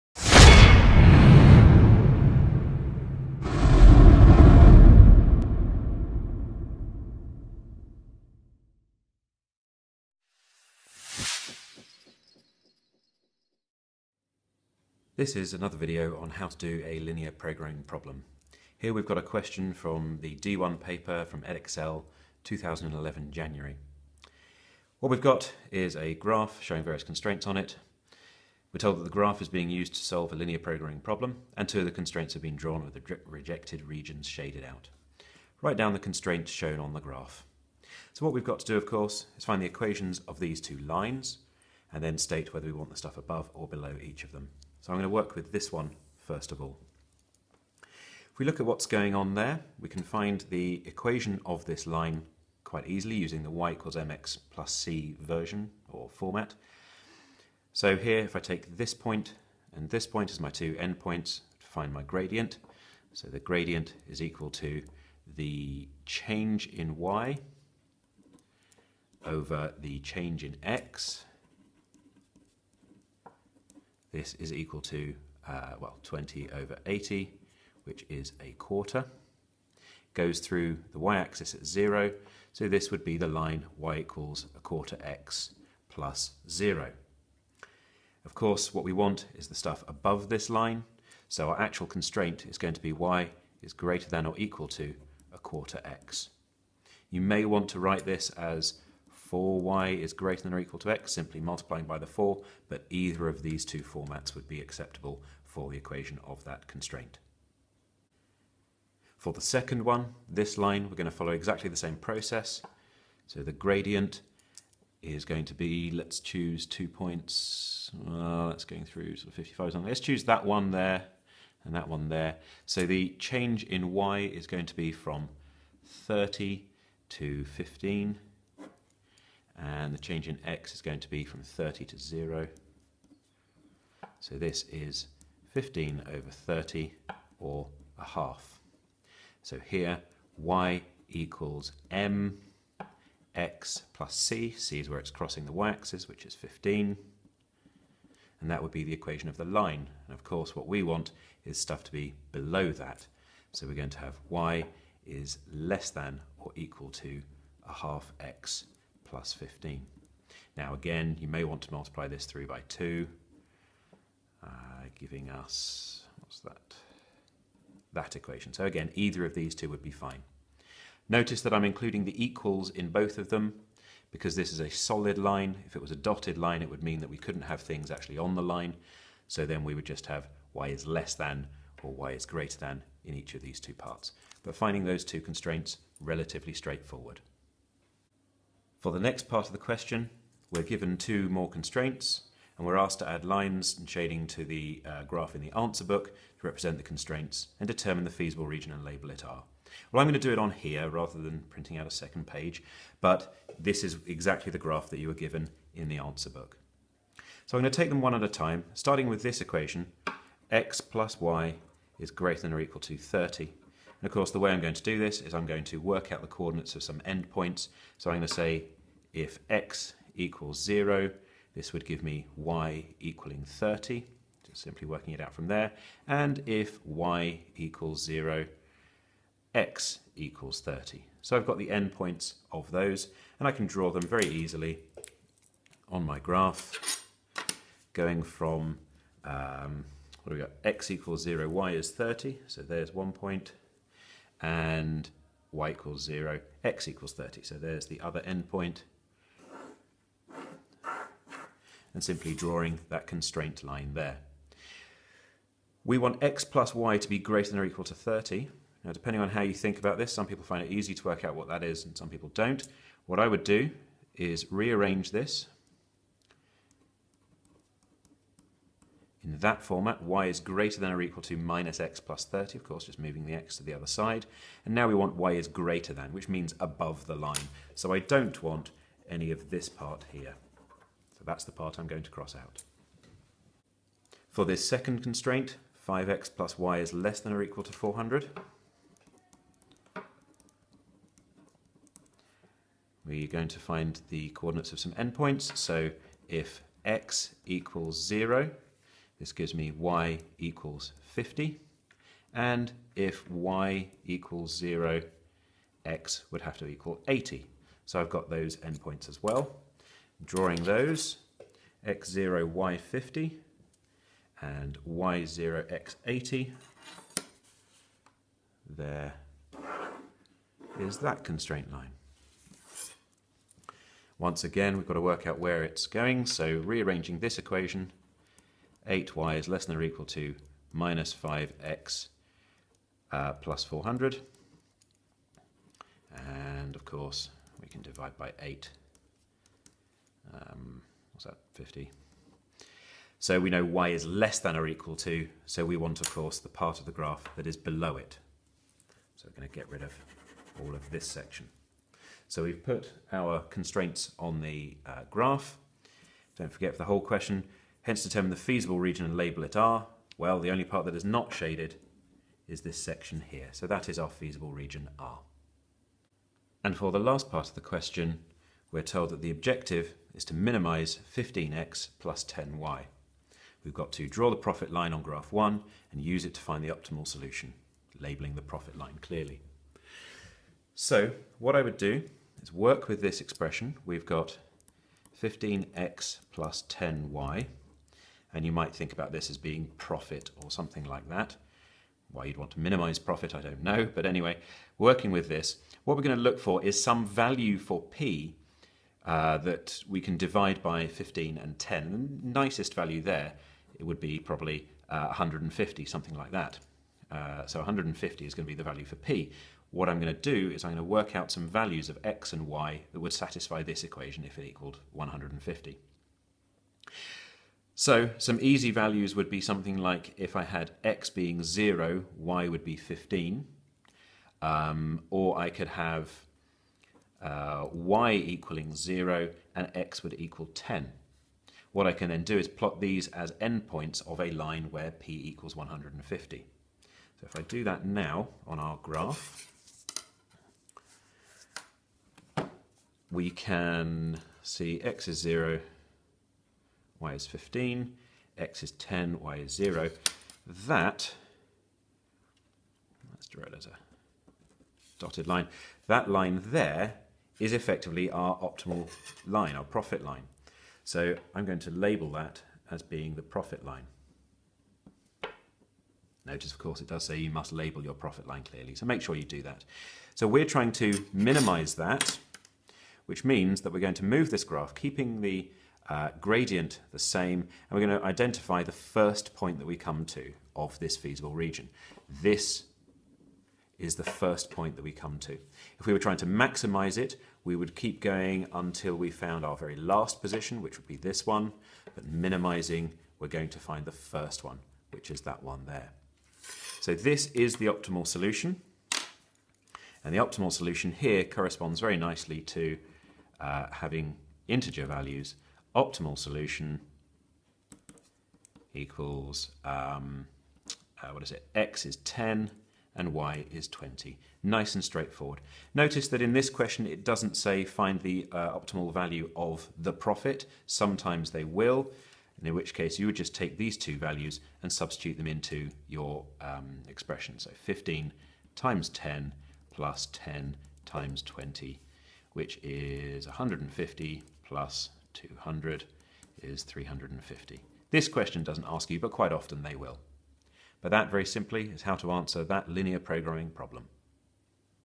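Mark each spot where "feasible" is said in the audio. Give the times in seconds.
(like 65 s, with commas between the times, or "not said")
198 s, 358 s, 364 s, 480 s.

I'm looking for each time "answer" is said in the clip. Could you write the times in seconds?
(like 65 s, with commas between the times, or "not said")
195 s, 205 s, 542 s.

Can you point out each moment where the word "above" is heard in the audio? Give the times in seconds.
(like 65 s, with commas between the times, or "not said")
43 s, 89 s, 276 s.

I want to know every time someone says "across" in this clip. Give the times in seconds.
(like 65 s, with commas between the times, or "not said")
not said.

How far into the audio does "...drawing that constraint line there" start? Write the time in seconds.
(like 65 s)
252 s.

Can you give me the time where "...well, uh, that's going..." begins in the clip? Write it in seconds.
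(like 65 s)
117 s.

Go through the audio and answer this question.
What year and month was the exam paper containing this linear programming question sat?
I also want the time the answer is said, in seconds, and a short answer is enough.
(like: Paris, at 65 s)
2011 January, at 22 s.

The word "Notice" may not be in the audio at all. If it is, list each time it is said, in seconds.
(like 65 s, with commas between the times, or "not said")
171 s, 466 s, 515 s.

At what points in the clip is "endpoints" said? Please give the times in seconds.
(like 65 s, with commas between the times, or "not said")
60 s, 217 s, 231 s, 248 s, 294 s, 308 s, 433 s.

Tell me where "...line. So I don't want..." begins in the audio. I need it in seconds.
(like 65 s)
277 s.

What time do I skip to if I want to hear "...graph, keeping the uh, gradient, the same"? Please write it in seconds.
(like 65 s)
474 s.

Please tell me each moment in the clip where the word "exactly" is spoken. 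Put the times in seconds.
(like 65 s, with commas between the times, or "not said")
111 s, 204 s.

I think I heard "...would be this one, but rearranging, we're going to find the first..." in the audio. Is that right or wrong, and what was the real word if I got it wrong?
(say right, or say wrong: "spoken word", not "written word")
wrong: "minimizing", not "rearranging".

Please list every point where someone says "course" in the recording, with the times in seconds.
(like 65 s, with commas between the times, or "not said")
38 s, 88 s, 150 s, 214 s, 272 s, 336 s, 346 s, 466 s.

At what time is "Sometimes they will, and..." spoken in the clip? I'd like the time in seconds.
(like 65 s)
520 s.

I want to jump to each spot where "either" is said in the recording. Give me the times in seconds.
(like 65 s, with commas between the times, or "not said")
102 s, 168 s.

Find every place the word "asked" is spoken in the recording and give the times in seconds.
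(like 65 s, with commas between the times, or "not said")
192 s.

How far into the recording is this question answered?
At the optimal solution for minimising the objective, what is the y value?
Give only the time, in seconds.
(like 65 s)
513 s.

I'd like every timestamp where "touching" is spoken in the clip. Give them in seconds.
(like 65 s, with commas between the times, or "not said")
not said.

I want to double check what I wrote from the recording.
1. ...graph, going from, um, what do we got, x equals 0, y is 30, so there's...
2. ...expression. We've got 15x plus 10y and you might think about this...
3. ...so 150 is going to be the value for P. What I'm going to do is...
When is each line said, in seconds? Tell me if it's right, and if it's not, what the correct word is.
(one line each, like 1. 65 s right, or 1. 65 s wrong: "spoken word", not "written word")
1. 236 s right
2. 383 s right
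3. 407 s right.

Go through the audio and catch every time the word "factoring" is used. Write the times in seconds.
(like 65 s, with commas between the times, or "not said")
not said.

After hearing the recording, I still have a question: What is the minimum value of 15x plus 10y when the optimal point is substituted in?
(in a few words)
350.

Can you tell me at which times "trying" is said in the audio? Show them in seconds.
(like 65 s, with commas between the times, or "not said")
470 s, 485 s.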